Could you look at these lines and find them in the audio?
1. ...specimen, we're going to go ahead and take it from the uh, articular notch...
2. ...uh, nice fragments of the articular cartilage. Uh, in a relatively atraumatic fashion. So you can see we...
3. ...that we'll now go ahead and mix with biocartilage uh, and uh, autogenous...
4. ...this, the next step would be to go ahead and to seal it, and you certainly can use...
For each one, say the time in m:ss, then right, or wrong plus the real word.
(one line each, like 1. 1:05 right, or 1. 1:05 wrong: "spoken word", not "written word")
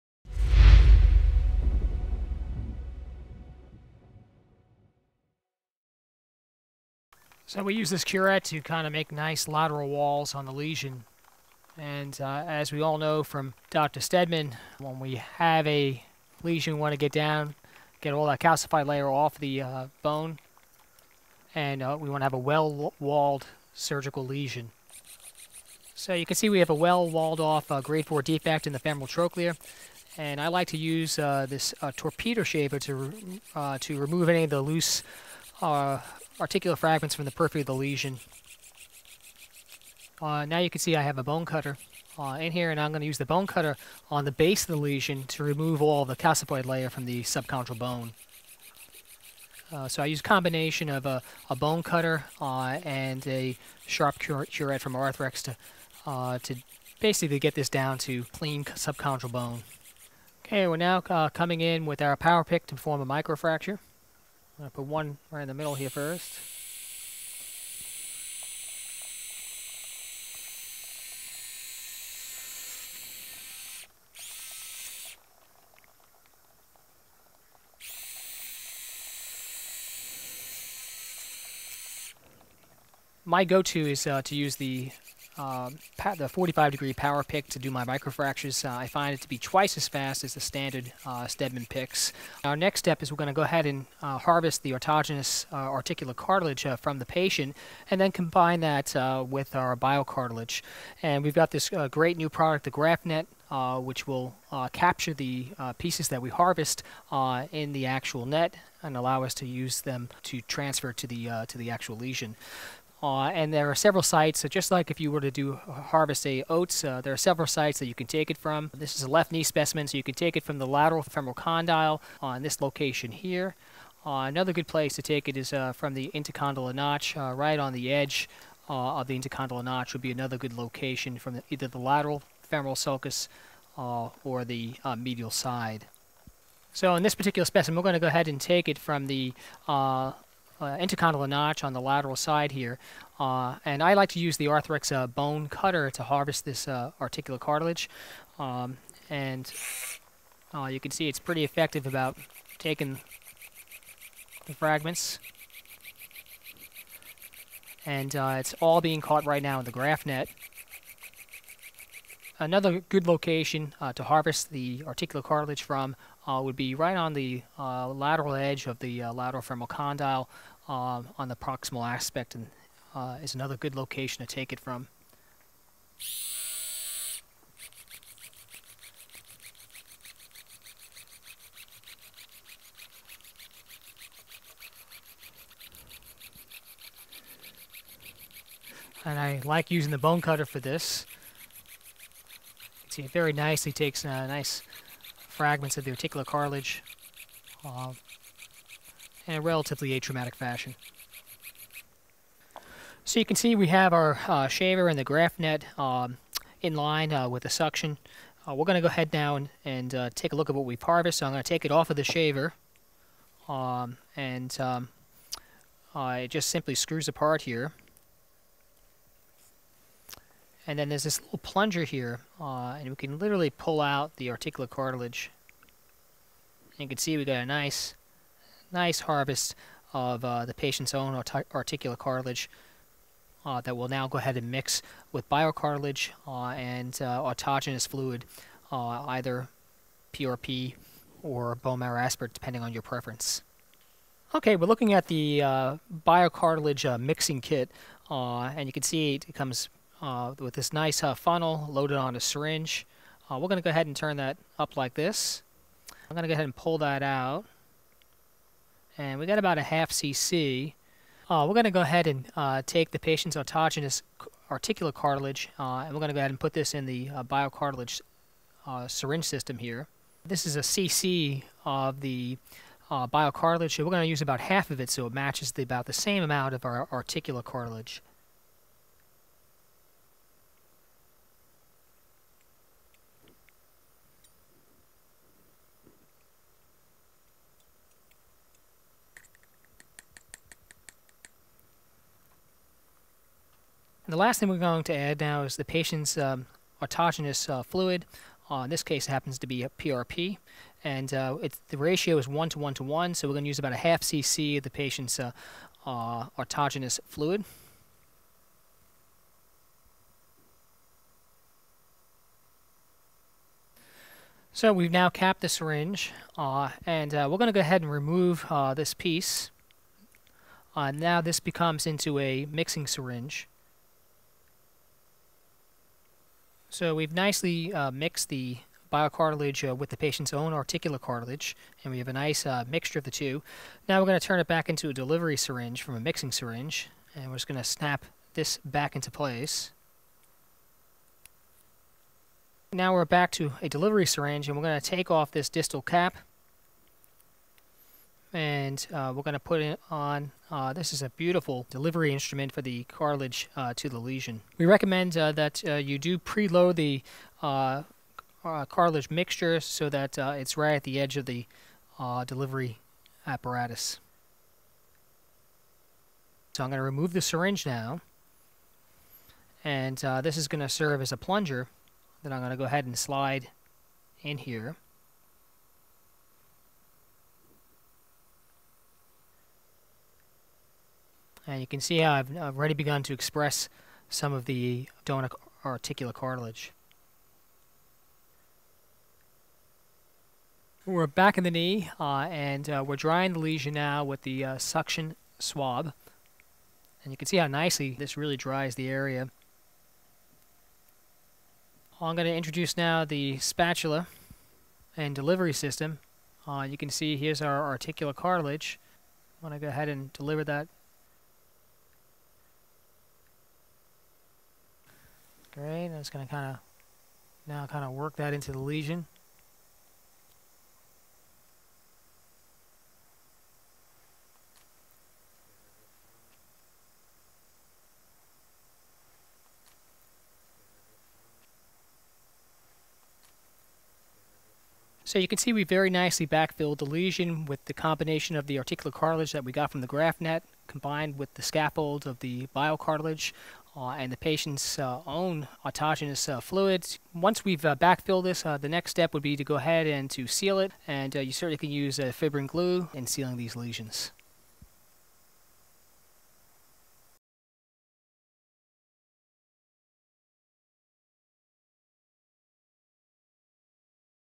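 1. 2:17 wrong: "intercondylar", not "articular"
2. 3:14 right
3. 3:53 right
4. 7:28 right.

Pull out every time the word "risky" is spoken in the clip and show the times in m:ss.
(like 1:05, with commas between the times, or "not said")
not said.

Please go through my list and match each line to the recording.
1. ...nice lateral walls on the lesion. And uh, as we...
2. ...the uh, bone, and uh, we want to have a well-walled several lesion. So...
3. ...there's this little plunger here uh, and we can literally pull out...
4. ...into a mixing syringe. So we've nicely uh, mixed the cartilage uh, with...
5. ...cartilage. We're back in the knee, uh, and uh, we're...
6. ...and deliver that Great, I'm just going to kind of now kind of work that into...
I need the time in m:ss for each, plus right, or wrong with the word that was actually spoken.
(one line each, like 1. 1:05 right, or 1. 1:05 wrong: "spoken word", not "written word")
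1. 0:09 right
2. 0:19 wrong: "surgical", not "several"
3. 3:40 right
4. 5:21 wrong: "biocartilage", not "cartilage"
5. 6:26 right
6. 6:49 right.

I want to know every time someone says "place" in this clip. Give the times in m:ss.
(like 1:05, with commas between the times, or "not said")
2:04, 5:39.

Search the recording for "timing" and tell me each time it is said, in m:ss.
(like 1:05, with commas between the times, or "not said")
not said.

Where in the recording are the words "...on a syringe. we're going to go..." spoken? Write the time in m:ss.
4:11.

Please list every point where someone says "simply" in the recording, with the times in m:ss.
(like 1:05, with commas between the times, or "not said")
3:36.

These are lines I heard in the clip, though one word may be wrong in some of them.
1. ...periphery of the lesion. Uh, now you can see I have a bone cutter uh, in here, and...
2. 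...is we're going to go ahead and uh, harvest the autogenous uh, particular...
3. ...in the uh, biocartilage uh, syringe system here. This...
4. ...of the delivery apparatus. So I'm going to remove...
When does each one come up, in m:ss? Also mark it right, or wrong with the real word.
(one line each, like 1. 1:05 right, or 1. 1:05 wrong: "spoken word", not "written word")
1. 0:37 right
2. 1:33 wrong: "articular", not "particular"
3. 4:26 right
4. 6:01 right.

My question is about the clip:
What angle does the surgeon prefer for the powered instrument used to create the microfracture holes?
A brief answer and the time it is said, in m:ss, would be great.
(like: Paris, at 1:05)
45 degree, at 1:26.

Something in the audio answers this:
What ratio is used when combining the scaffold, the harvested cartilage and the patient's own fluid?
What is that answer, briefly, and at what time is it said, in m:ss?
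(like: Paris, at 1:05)
1 to 1 to 1, at 5:02.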